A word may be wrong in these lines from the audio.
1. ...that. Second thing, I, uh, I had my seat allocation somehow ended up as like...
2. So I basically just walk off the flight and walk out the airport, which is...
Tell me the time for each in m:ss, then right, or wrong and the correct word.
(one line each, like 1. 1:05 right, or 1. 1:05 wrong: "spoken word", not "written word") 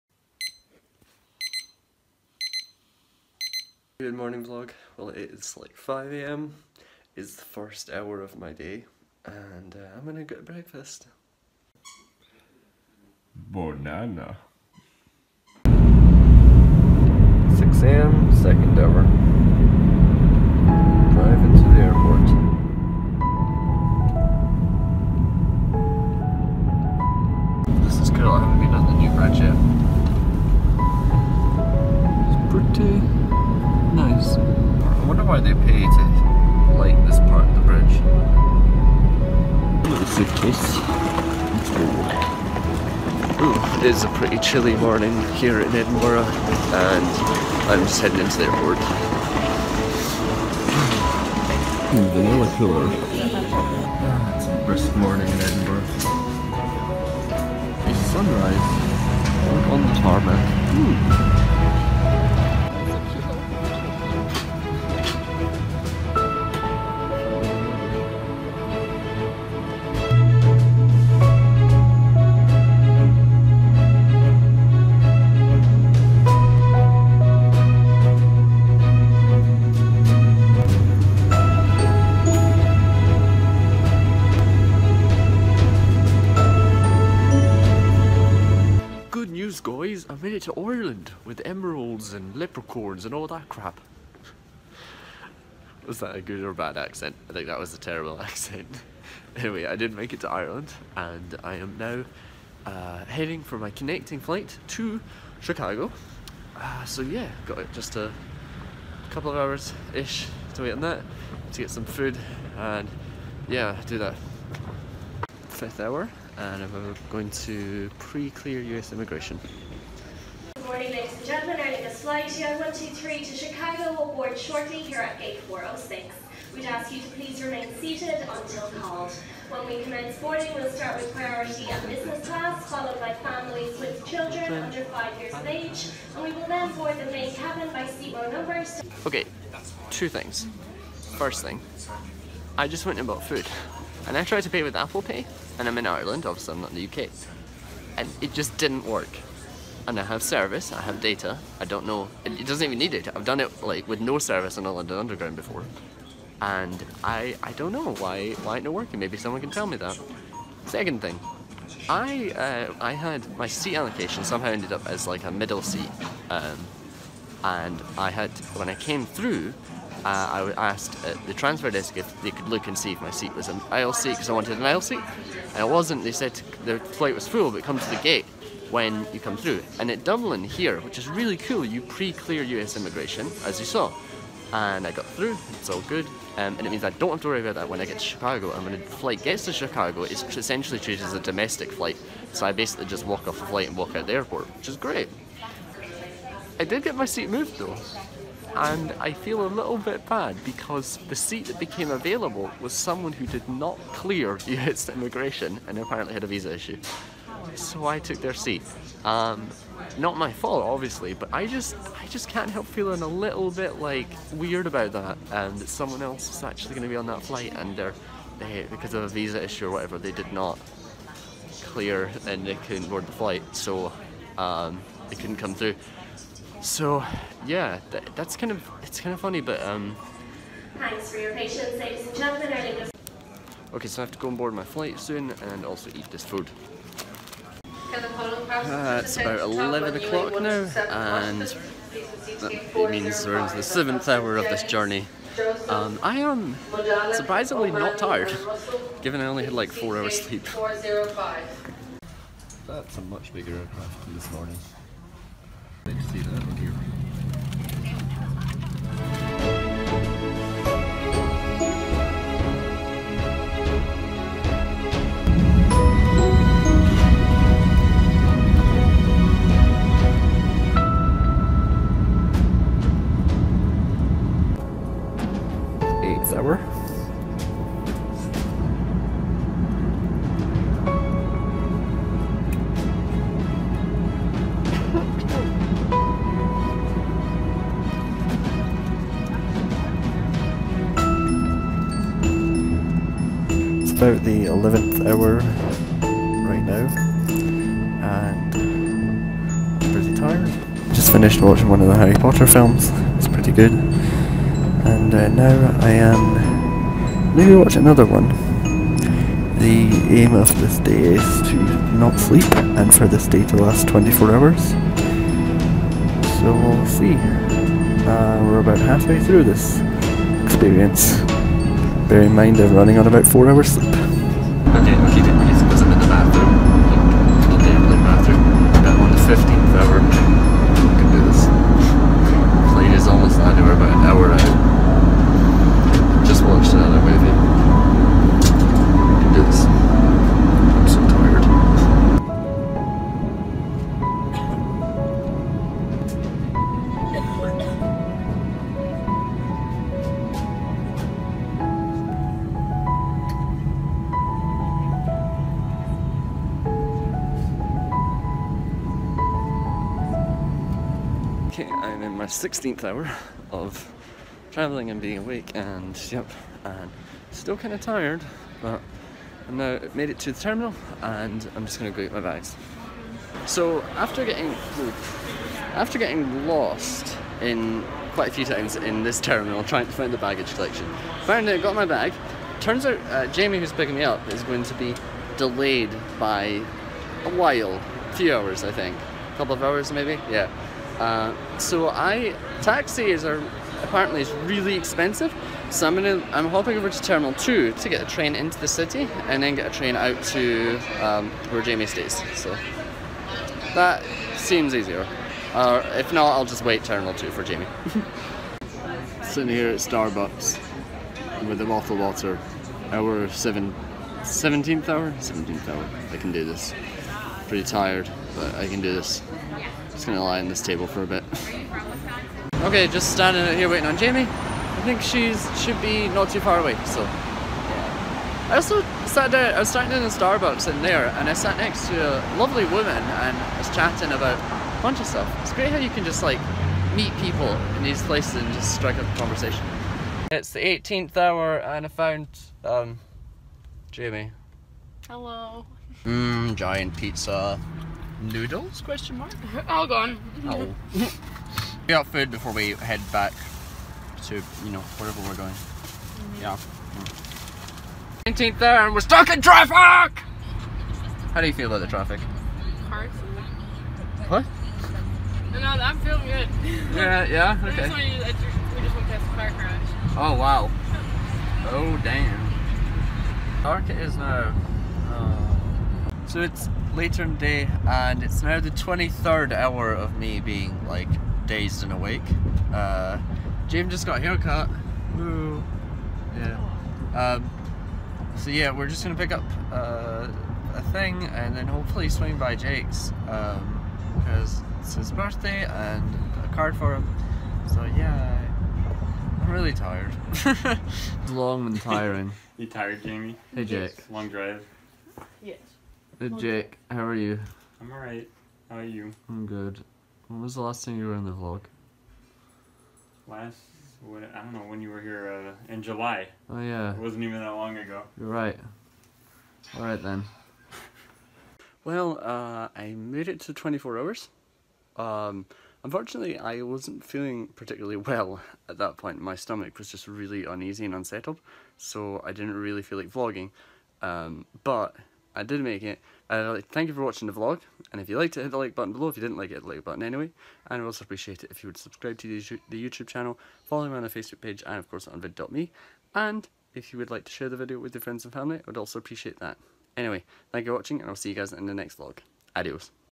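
1. 2:39 right
2. 3:12 right.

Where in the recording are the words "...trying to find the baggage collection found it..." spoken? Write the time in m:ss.
6:19.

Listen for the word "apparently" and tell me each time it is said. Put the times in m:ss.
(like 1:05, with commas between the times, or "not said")
3:25, 6:33.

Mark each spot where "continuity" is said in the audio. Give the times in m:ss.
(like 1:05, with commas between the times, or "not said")
not said.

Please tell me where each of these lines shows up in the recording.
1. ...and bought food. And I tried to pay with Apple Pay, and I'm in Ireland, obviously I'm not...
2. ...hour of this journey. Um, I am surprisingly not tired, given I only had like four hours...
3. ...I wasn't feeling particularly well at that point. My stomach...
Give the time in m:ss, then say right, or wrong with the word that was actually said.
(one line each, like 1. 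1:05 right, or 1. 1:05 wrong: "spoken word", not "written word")
1. 2:22 right
2. 4:04 right
3. 8:46 right.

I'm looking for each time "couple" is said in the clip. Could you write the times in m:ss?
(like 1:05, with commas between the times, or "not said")
1:49, 6:29.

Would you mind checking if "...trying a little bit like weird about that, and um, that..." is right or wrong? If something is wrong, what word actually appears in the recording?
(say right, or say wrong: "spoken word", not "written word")
wrong: "feeling", not "trying".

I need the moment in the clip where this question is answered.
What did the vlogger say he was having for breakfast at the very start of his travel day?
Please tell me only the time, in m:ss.
0:13.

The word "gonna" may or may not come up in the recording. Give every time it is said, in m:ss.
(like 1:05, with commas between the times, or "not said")
0:10, 6:11, 6:35, 7:00, 8:09.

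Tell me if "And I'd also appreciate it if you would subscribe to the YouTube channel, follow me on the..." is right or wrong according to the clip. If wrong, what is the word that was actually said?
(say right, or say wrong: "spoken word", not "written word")
right.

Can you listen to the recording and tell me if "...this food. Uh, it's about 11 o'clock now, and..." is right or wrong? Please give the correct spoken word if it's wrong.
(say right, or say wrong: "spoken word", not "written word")
right.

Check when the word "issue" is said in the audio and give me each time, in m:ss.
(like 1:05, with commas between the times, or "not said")
3:26, 3:39.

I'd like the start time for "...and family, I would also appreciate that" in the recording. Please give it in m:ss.
9:08.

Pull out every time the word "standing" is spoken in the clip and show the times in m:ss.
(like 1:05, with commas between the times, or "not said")
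7:03, 7:09.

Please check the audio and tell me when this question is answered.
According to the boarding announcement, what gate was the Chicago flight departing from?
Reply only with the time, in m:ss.
2:05.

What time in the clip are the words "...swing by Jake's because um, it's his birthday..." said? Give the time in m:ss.
8:12.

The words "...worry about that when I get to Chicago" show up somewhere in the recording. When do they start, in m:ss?
3:07.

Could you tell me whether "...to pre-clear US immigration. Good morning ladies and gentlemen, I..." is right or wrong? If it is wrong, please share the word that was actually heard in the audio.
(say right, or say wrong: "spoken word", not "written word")
right.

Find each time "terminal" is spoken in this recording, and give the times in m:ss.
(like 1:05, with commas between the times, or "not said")
6:10, 6:19, 6:37, 6:46.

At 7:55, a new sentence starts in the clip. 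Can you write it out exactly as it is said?
Uh, uh so it's later in the day, and it's now the 23rd hour of me being like dazed and awake.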